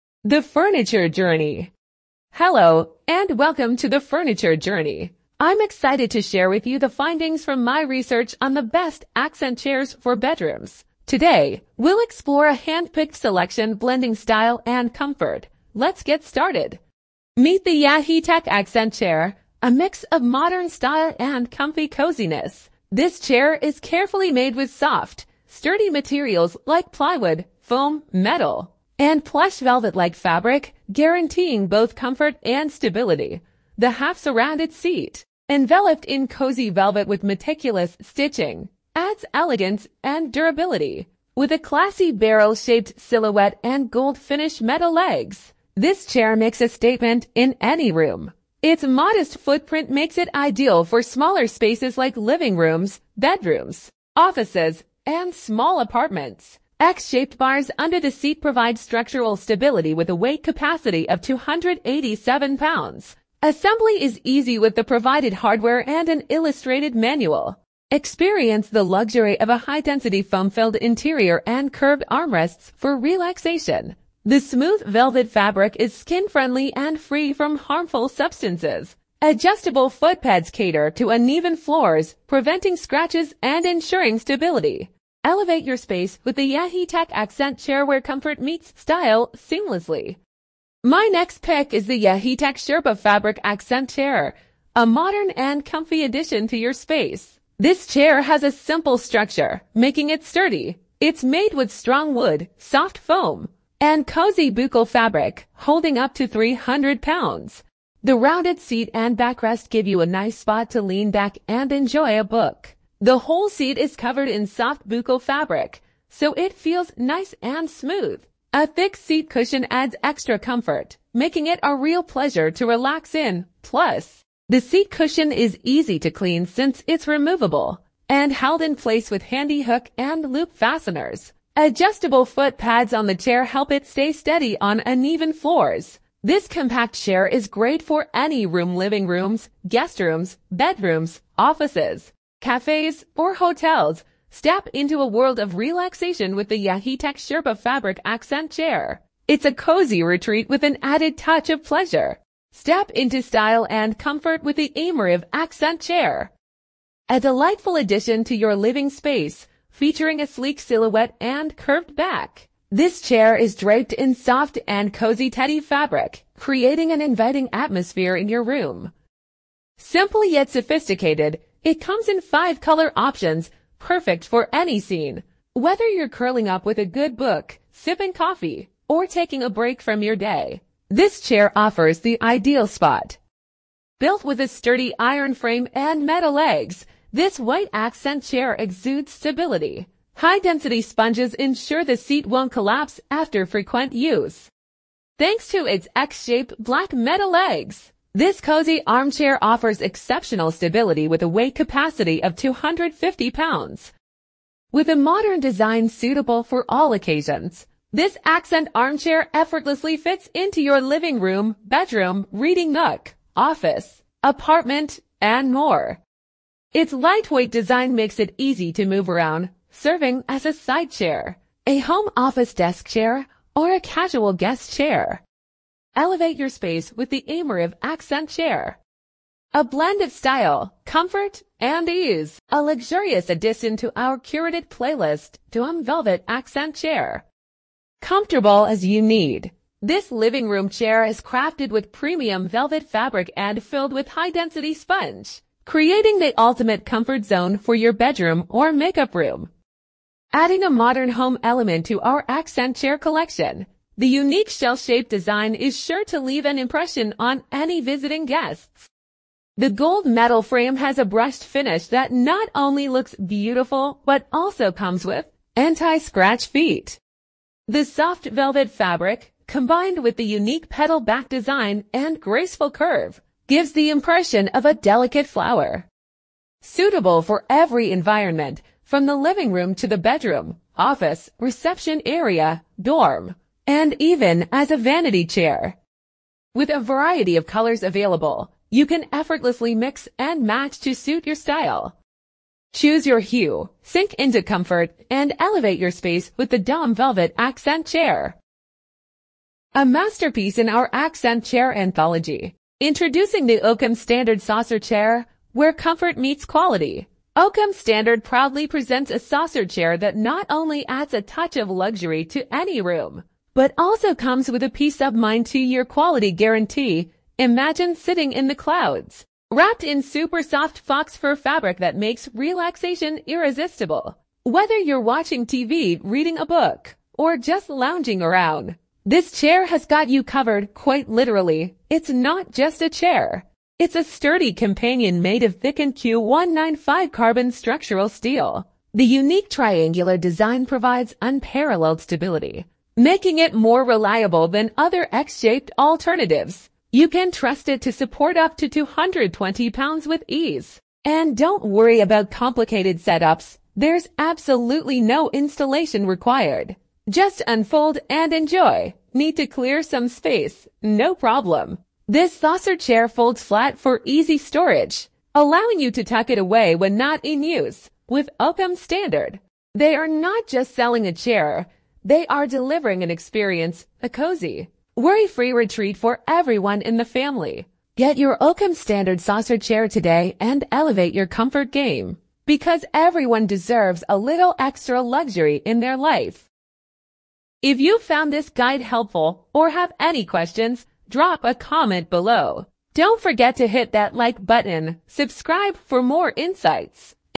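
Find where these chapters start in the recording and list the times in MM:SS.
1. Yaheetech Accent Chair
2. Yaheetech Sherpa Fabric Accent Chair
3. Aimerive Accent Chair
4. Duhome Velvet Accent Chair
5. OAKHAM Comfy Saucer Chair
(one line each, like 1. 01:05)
1. 00:17
2. 01:31
3. 02:32
4. 03:52
5. 05:02.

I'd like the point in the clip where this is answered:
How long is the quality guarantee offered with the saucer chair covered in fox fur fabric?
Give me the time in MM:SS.
05:15.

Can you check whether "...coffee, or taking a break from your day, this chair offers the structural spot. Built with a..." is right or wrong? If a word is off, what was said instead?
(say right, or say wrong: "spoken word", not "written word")
wrong: "ideal", not "structural".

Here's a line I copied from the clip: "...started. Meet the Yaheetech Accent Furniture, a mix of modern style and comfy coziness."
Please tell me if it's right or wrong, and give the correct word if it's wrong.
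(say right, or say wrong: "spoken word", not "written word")
wrong: "Chair", not "Furniture".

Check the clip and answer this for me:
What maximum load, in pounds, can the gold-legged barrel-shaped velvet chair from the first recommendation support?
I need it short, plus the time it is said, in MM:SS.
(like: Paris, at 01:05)
287 pounds, at 01:01.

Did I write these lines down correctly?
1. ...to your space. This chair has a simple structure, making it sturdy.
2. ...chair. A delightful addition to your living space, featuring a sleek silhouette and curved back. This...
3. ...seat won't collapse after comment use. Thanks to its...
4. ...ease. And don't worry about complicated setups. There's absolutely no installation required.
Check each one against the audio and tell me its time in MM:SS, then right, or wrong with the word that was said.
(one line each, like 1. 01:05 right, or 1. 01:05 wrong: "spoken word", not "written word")
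1. 01:36 right
2. 02:35 right
3. 03:11 wrong: "frequent", not "comment"
4. 05:50 right.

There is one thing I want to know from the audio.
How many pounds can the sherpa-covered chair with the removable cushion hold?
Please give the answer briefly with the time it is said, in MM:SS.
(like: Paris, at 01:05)
300 pounds, at 01:46.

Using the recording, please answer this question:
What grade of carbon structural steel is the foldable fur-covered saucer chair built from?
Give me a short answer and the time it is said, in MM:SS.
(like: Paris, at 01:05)
Q195, at 05:35.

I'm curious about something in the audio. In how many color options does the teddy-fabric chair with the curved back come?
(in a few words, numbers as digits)
5.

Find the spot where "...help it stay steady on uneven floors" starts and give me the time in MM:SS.
02:13.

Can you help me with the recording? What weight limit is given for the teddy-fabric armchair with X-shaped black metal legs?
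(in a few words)
250 pounds.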